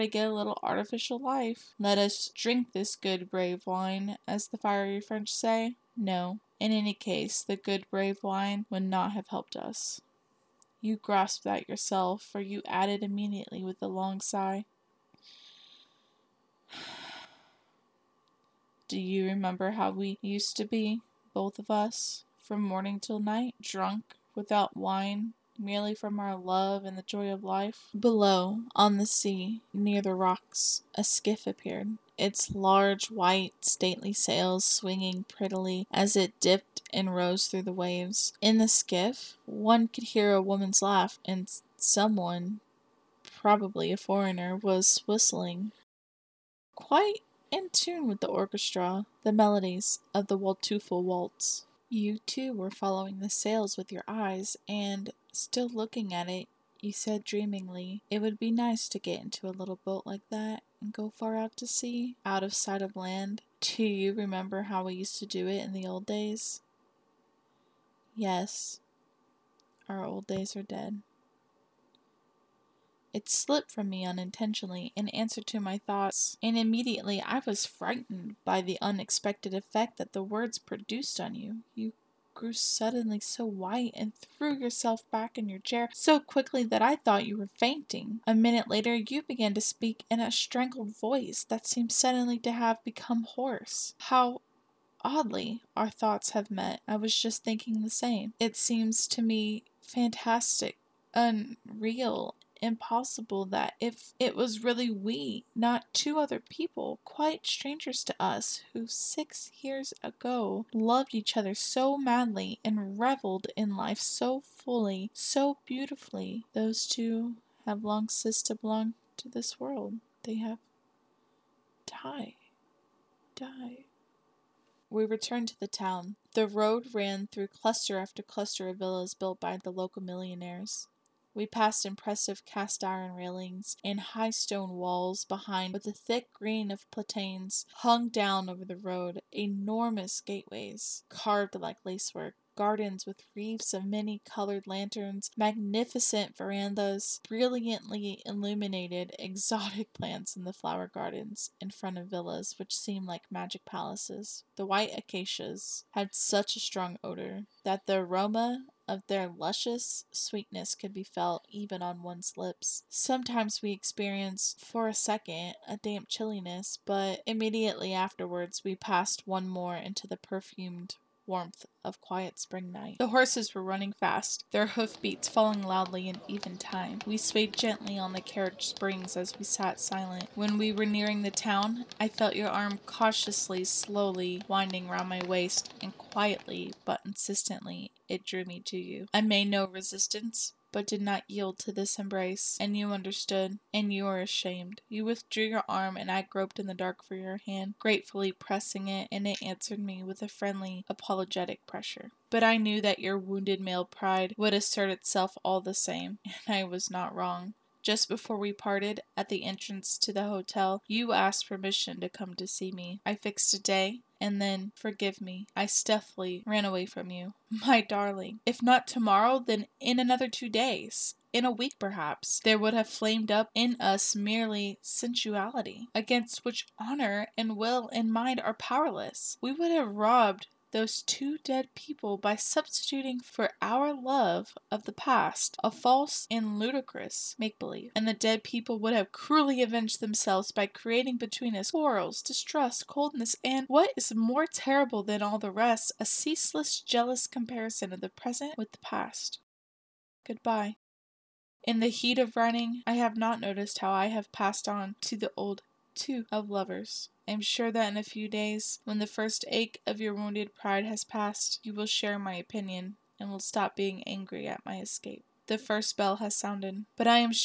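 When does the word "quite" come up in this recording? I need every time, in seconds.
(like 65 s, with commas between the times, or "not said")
46 s, 107 s.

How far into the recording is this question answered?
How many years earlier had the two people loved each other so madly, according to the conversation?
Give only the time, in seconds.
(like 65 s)
108 s.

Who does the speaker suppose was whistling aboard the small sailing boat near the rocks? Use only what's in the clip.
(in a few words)
A foreigner.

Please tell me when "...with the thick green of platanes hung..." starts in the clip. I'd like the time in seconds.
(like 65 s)
135 s.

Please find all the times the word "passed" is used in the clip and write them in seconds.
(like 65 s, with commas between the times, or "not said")
131 s, 168 s, 254 s, 261 s.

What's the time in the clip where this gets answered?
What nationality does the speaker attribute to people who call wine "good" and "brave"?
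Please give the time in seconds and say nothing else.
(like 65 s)
4 s.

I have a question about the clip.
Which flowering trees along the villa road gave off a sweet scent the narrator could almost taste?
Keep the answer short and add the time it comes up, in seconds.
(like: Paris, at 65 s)
White acacias, at 154 s.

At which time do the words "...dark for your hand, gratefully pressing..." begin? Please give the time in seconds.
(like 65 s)
196 s.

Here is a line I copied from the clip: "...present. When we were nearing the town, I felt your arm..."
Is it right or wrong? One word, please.
wrong.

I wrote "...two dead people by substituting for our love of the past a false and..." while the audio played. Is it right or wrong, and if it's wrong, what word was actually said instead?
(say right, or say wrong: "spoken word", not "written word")
right.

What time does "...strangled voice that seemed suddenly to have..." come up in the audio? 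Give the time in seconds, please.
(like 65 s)
90 s.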